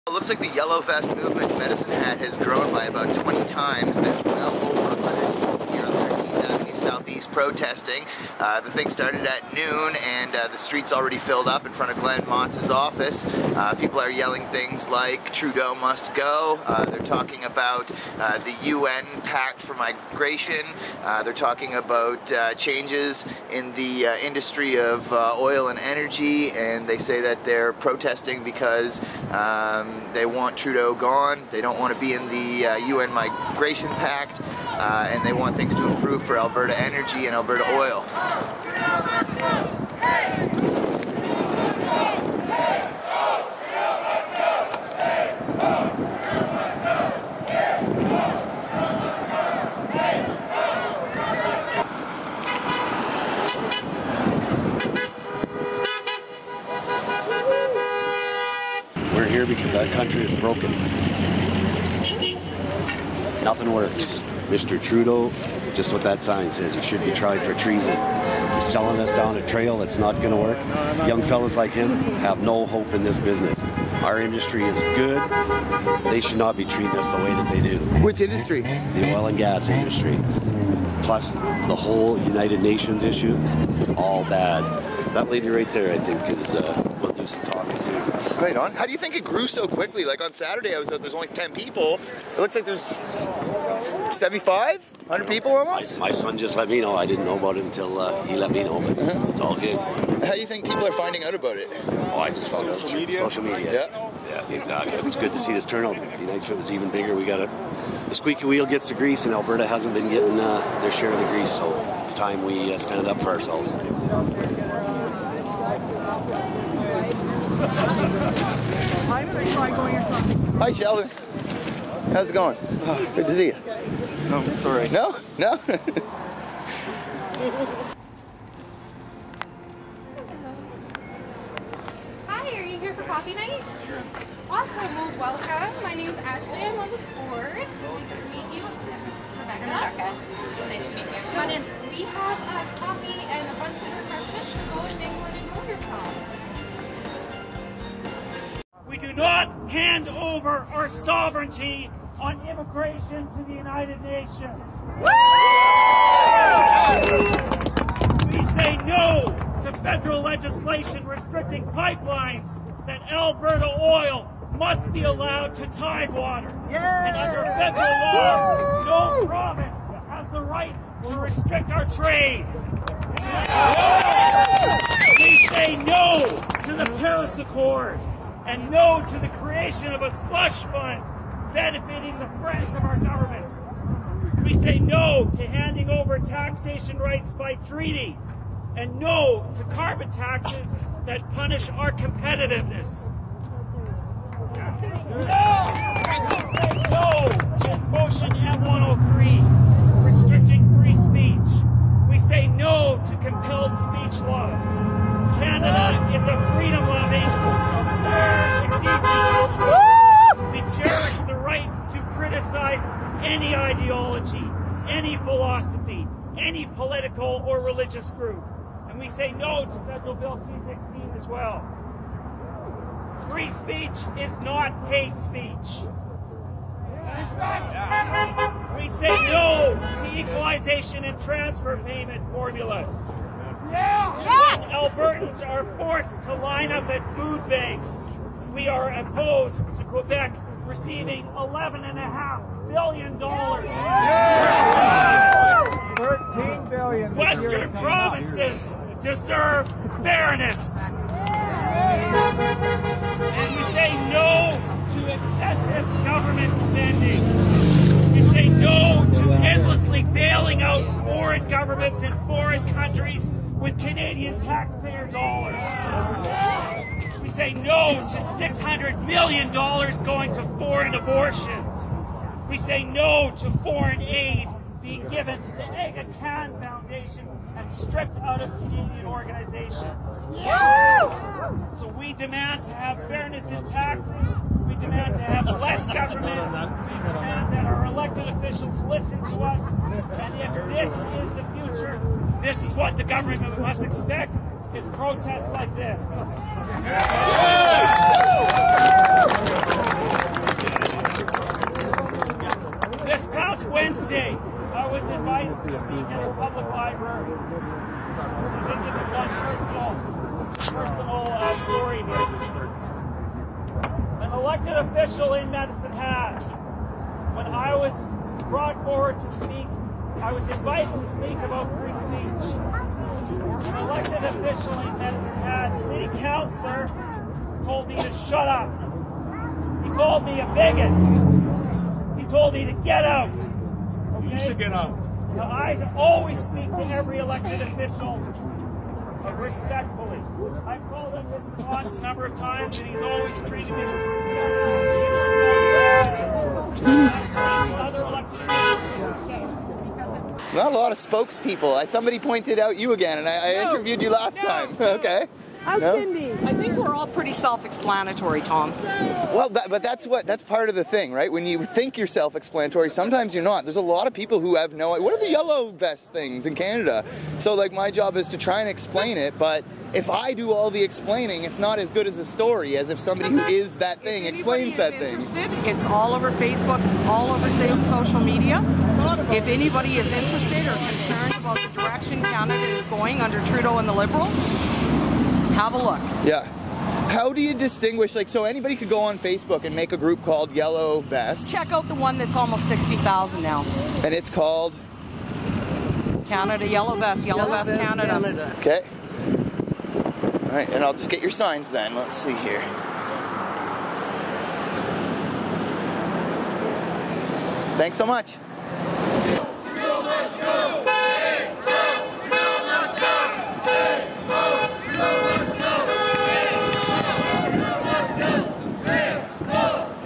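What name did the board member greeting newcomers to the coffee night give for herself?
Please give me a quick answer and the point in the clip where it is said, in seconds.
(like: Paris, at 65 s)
Ashley, at 136 s.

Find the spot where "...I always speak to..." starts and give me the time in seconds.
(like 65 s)
335 s.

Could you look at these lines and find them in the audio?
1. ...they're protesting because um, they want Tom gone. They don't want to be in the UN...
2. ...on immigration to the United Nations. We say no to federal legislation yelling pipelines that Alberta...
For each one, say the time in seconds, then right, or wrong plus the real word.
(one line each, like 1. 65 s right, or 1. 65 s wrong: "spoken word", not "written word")
1. 27 s wrong: "Trudeau", not "Tom"
2. 152 s wrong: "restricting", not "yelling".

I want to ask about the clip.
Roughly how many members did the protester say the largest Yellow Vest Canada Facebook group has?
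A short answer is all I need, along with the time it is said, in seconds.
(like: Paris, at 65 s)
60,000, at 392 s.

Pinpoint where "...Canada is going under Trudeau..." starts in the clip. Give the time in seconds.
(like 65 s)
382 s.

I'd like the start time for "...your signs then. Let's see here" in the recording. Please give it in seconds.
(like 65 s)
401 s.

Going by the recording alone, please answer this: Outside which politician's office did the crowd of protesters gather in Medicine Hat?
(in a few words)
Glen Motz.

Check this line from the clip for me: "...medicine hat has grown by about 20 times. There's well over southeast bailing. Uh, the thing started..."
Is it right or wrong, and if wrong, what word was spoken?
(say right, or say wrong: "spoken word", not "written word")
wrong: "protesting", not "bailing".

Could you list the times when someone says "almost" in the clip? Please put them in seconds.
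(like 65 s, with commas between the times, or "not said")
95 s, 392 s.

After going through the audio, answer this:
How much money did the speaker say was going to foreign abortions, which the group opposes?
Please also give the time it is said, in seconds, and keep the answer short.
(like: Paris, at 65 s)
$600 million, at 268 s.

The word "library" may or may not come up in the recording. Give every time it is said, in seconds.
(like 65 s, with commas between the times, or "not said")
306 s.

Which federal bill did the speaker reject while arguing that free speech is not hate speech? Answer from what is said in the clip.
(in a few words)
Bill C-16.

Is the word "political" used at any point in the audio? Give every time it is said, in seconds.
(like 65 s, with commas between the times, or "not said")
216 s.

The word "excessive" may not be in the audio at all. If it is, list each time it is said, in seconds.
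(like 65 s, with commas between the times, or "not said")
255 s.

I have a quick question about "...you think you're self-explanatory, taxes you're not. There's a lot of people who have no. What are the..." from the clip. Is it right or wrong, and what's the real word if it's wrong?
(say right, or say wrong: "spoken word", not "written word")
wrong: "sometimes", not "taxes".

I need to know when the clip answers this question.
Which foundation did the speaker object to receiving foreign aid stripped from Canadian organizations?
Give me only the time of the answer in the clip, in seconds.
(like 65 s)
275 s.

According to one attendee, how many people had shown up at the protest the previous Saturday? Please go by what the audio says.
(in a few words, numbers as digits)
10.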